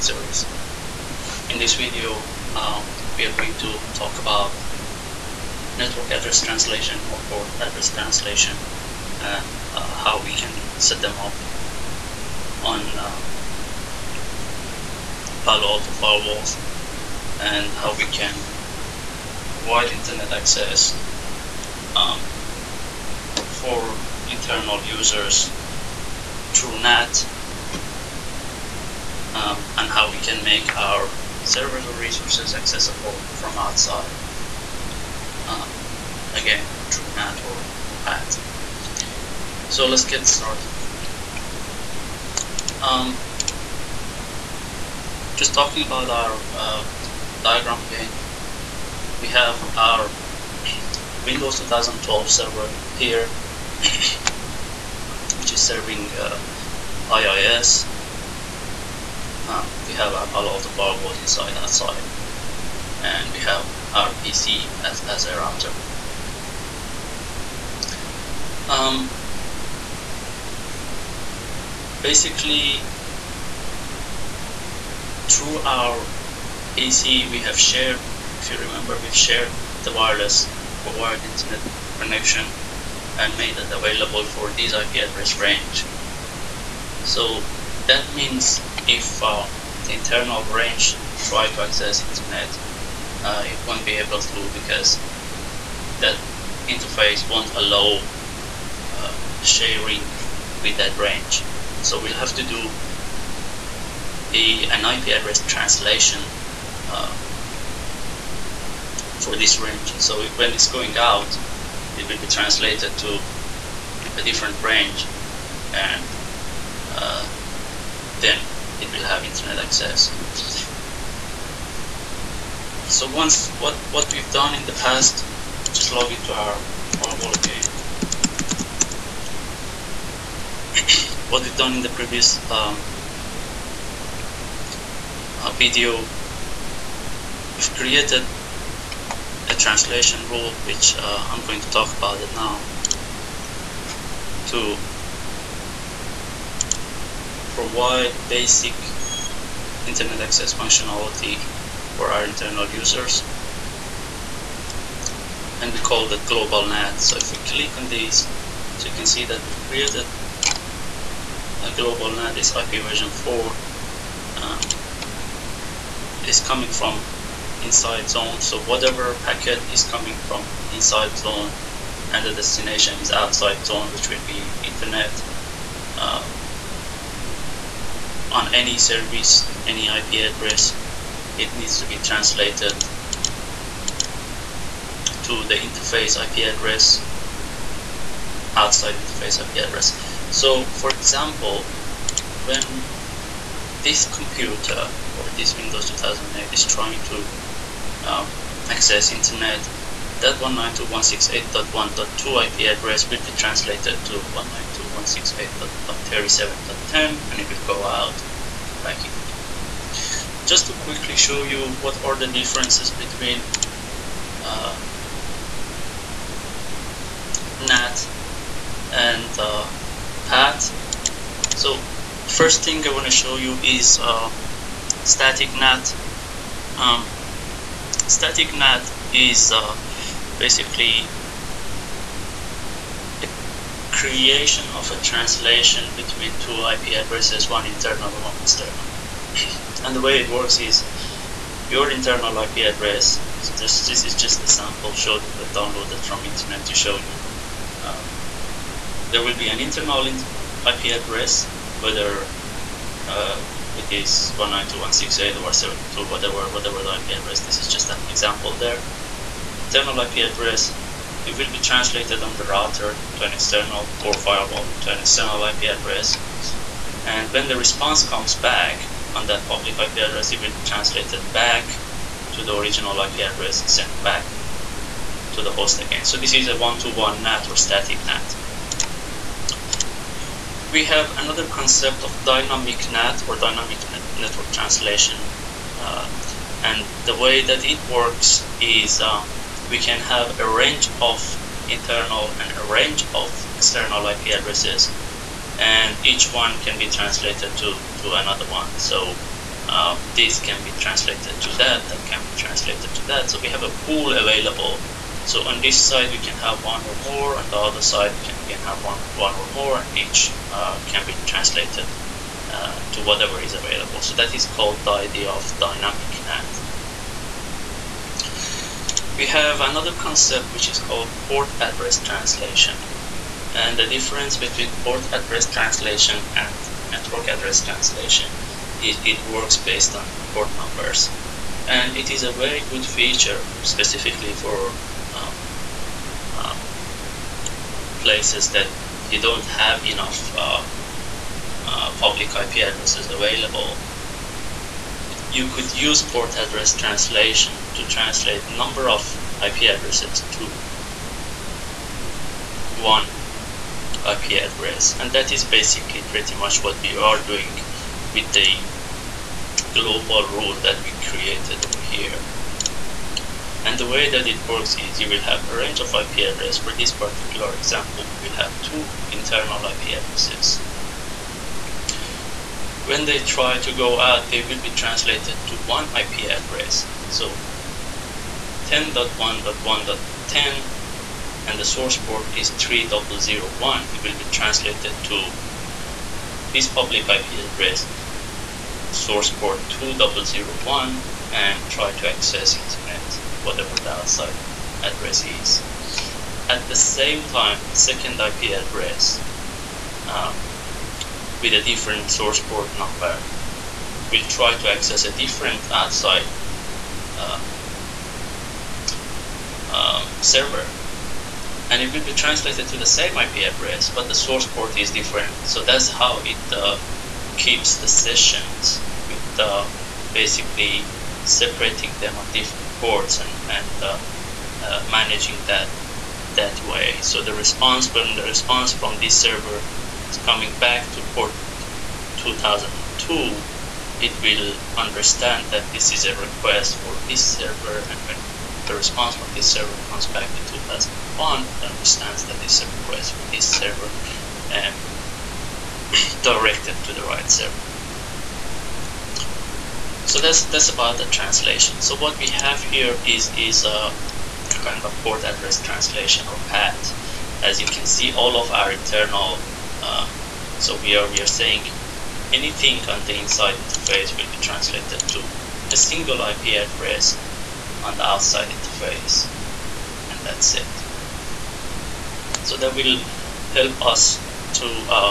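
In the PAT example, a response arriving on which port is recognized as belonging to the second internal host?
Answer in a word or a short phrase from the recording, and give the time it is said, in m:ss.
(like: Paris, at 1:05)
2002, at 7:12.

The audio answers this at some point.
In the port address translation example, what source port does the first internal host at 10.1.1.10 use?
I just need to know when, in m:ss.
6:22.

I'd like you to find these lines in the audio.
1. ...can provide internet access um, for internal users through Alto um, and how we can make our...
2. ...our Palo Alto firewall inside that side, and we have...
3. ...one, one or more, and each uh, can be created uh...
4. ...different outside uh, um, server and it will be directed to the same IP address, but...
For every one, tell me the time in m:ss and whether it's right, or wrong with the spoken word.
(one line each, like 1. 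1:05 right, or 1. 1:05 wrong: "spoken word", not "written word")
1. 0:18 wrong: "NAT", not "Alto"
2. 1:00 right
3. 5:08 wrong: "translated", not "created"
4. 6:45 wrong: "translated", not "directed".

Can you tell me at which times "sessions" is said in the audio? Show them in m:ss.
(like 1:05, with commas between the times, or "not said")
6:57.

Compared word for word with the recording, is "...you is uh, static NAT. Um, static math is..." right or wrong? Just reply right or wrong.
right.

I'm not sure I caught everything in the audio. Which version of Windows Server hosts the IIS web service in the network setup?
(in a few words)
Windows 2012.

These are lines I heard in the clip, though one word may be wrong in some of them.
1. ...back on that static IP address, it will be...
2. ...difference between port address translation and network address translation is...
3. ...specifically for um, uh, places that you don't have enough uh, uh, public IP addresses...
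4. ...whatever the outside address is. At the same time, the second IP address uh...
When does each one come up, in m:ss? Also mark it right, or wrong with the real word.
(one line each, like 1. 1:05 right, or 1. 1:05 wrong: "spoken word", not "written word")
1. 4:28 wrong: "public", not "static"
2. 5:23 right
3. 5:33 right
4. 6:33 right.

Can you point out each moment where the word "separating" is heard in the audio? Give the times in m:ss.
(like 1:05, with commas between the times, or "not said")
7:01.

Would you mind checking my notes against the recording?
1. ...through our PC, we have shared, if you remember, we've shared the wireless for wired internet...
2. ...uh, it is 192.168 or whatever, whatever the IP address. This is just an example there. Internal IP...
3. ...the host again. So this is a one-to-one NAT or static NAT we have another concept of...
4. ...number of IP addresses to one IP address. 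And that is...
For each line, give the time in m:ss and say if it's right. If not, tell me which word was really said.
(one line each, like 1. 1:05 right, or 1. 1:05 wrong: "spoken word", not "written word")
1. 1:15 right
2. 4:13 right
3. 4:35 right
4. 5:48 right.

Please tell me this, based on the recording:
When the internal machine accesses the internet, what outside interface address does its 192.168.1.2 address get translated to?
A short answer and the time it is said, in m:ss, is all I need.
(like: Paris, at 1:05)
192.168.137.10, at 3:24.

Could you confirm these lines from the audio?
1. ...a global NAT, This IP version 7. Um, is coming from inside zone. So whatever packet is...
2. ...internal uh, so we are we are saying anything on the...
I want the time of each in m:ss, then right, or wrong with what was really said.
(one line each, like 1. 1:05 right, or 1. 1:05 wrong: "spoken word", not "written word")
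1. 2:41 wrong: "4", not "7"
2. 7:38 right.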